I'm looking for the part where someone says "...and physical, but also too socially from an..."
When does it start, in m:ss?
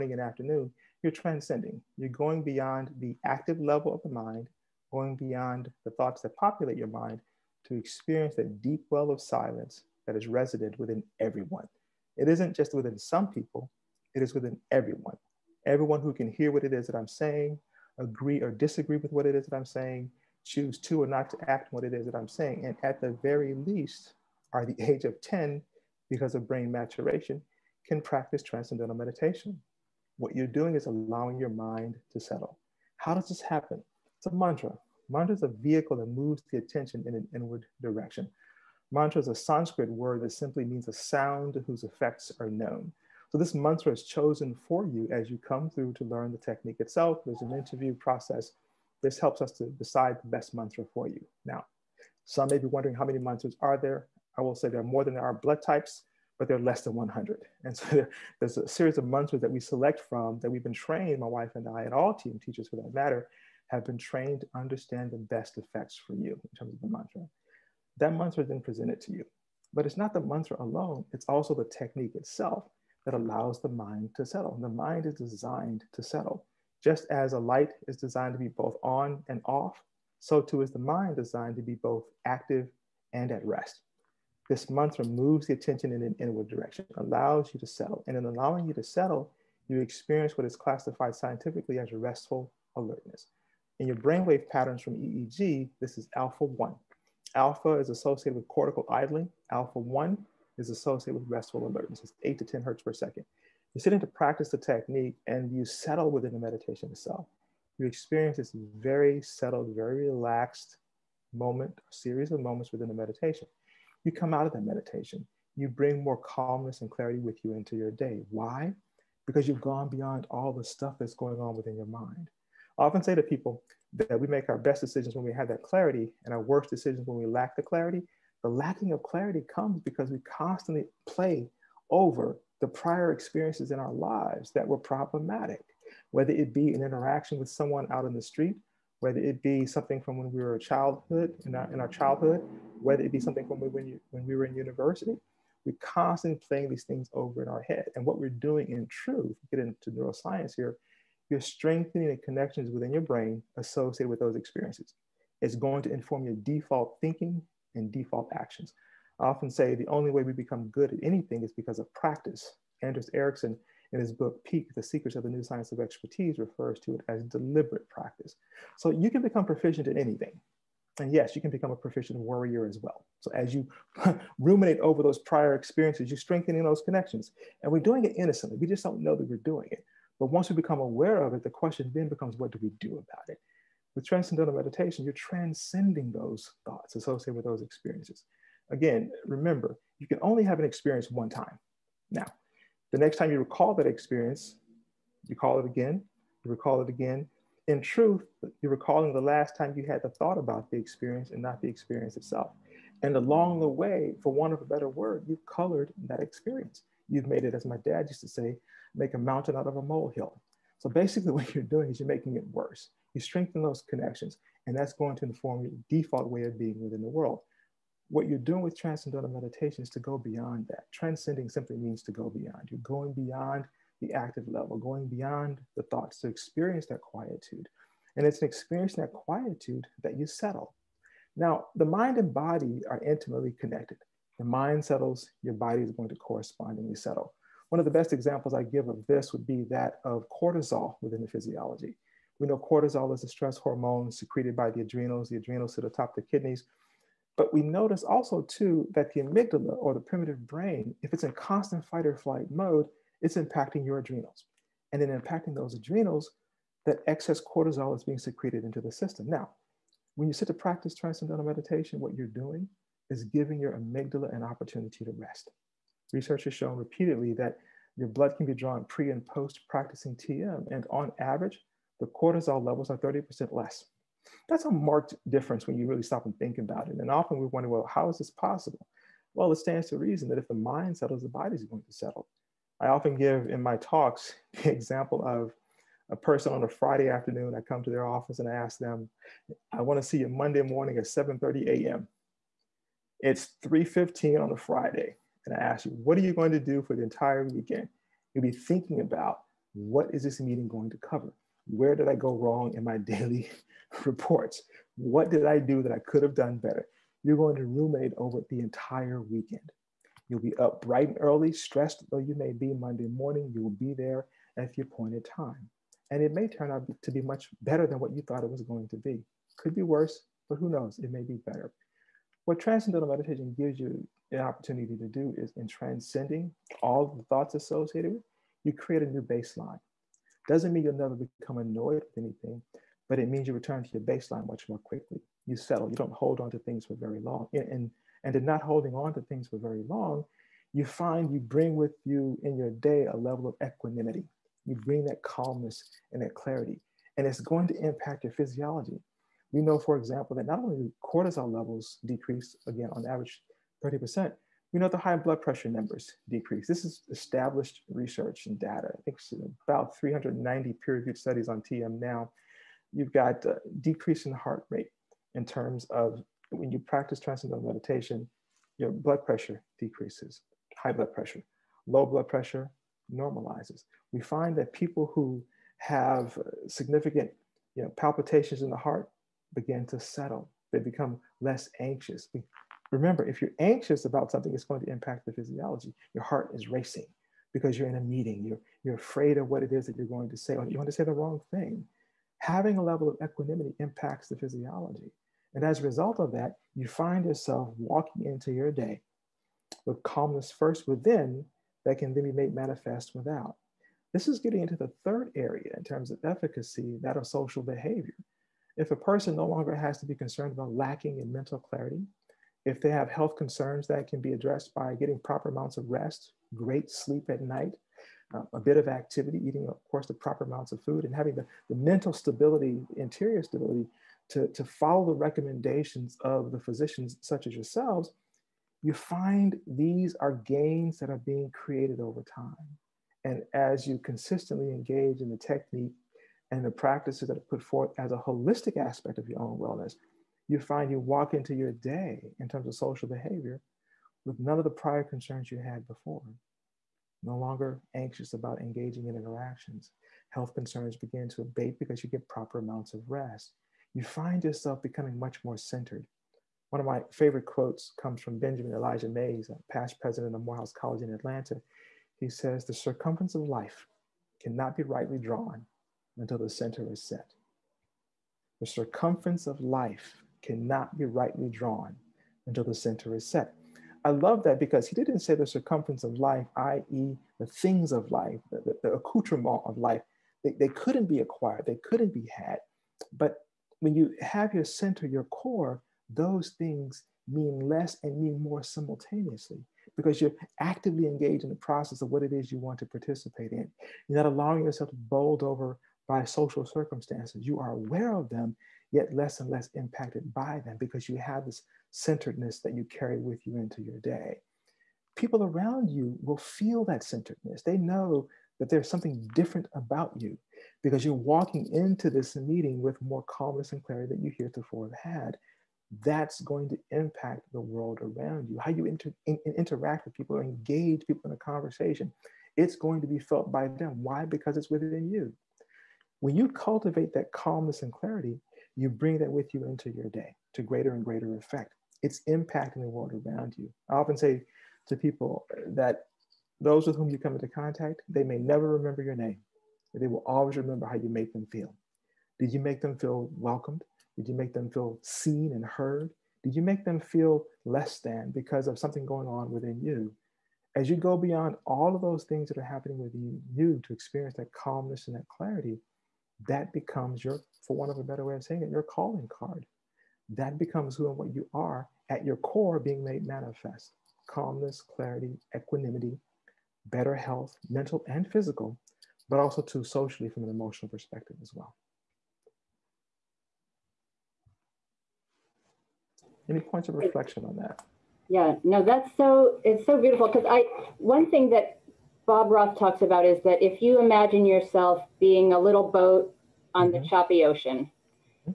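9:28.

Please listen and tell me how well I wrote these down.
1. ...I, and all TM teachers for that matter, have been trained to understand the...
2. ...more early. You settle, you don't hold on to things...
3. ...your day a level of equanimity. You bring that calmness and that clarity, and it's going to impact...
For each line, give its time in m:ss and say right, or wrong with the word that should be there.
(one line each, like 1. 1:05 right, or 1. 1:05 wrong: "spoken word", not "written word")
1. 1:01 right
2. 5:34 wrong: "quickly", not "early"
3. 5:42 right.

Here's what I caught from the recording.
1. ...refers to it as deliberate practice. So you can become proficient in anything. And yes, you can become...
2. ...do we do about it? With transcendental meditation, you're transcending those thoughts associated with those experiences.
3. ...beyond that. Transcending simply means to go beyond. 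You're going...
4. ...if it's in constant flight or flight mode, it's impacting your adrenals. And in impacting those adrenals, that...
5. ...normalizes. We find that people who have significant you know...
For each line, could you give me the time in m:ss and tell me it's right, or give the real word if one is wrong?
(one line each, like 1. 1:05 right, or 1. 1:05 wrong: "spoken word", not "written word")
1. 2:46 right
2. 3:02 right
3. 3:40 right
4. 4:11 wrong: "fight", not "flight"
5. 6:13 right.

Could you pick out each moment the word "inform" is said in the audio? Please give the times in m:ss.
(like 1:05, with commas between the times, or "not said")
2:35, 3:35.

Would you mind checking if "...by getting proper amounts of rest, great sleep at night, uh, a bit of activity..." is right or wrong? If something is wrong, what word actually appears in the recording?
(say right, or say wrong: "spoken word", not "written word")
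right.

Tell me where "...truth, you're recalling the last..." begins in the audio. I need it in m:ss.
3:17.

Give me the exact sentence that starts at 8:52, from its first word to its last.
It's impacting the world around you.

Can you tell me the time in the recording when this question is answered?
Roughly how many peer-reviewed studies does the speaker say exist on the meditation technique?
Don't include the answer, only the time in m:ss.
5:59.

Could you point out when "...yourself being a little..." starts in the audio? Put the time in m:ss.
9:44.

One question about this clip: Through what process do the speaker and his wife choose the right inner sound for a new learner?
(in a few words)
Interview process.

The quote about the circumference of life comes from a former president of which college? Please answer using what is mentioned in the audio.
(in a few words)
Morehouse College.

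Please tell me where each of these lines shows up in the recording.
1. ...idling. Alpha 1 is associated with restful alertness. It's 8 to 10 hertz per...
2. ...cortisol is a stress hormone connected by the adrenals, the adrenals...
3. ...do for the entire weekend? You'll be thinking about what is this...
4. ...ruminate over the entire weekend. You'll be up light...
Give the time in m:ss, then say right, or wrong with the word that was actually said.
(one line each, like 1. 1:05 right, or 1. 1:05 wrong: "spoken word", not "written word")
1. 1:38 right
2. 4:02 wrong: "secreted", not "connected"
3. 4:56 right
4. 5:07 wrong: "bright", not "light".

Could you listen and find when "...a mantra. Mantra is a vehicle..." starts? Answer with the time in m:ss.
0:34.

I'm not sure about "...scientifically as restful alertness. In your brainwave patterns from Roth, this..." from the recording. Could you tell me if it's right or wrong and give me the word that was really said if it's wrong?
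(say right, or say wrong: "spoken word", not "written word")
wrong: "EEG", not "Roth".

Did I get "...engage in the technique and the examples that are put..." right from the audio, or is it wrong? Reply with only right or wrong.
wrong.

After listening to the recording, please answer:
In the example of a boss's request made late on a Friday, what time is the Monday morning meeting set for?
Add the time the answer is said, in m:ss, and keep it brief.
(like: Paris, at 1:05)
7:30 a.m., at 4:51.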